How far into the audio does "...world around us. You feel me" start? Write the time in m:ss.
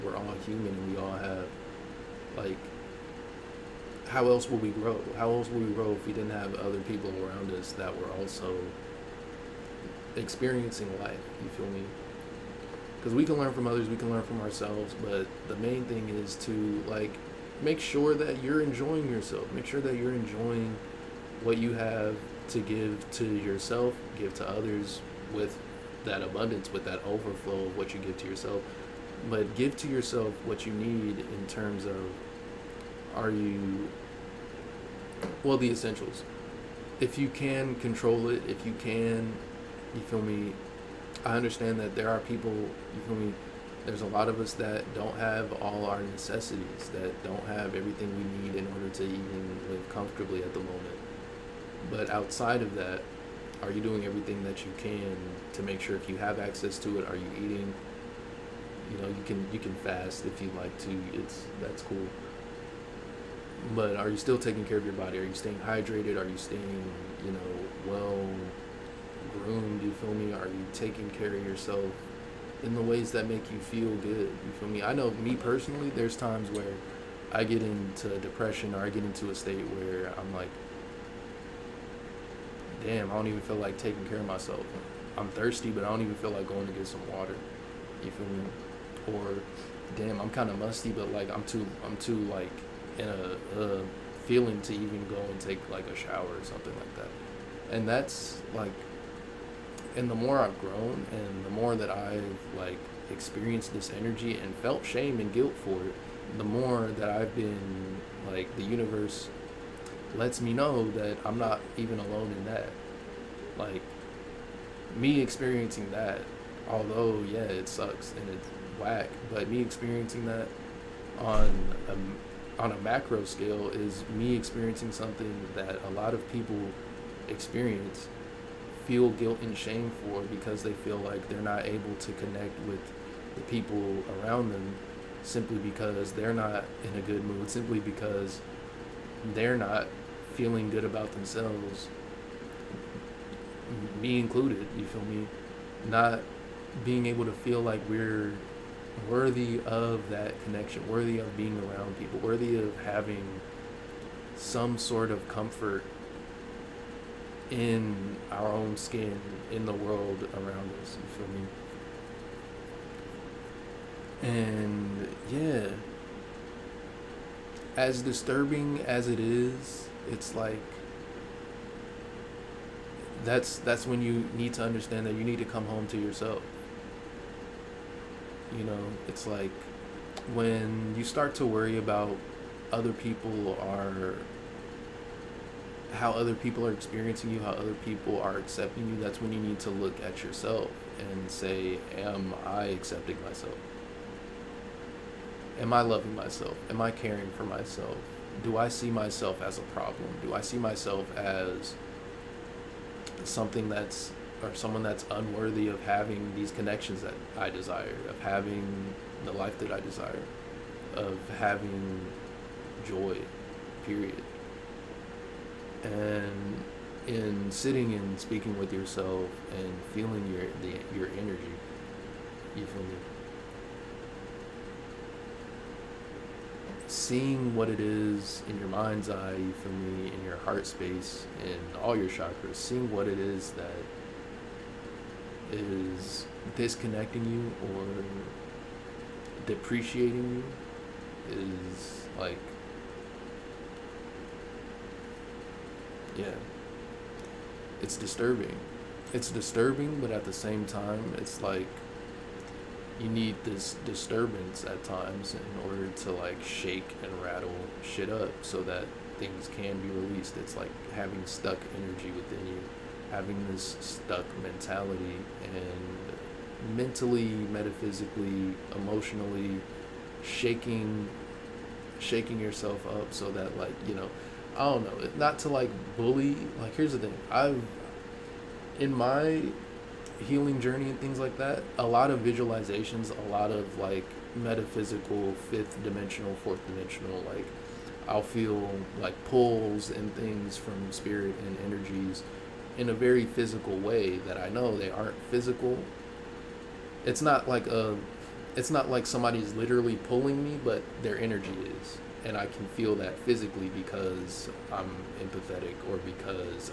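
2:39.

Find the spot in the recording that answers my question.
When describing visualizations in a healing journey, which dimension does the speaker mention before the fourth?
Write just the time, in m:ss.
4:45.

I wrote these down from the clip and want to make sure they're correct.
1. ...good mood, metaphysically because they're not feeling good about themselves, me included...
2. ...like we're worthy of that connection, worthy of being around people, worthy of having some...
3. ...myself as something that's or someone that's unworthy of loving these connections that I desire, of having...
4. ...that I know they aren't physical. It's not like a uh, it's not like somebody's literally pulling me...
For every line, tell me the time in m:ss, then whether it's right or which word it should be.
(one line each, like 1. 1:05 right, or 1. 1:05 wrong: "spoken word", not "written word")
1. 2:17 wrong: "simply", not "metaphysically"
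2. 2:27 right
3. 3:20 wrong: "having", not "loving"
4. 4:54 right.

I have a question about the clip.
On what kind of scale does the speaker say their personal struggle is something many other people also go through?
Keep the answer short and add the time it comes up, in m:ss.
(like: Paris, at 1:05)
macro scale, at 2:02.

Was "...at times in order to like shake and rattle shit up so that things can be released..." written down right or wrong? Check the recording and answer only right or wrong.
right.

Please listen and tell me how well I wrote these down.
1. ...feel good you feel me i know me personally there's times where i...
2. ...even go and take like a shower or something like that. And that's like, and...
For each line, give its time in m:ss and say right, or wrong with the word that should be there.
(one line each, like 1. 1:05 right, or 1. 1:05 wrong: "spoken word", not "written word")
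1. 1:13 right
2. 1:34 right.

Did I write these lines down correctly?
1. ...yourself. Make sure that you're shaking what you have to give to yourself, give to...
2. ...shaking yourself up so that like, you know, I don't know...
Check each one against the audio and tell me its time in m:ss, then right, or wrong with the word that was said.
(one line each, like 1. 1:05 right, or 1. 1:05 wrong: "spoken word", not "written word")
1. 0:19 wrong: "enjoying", not "shaking"
2. 4:31 right.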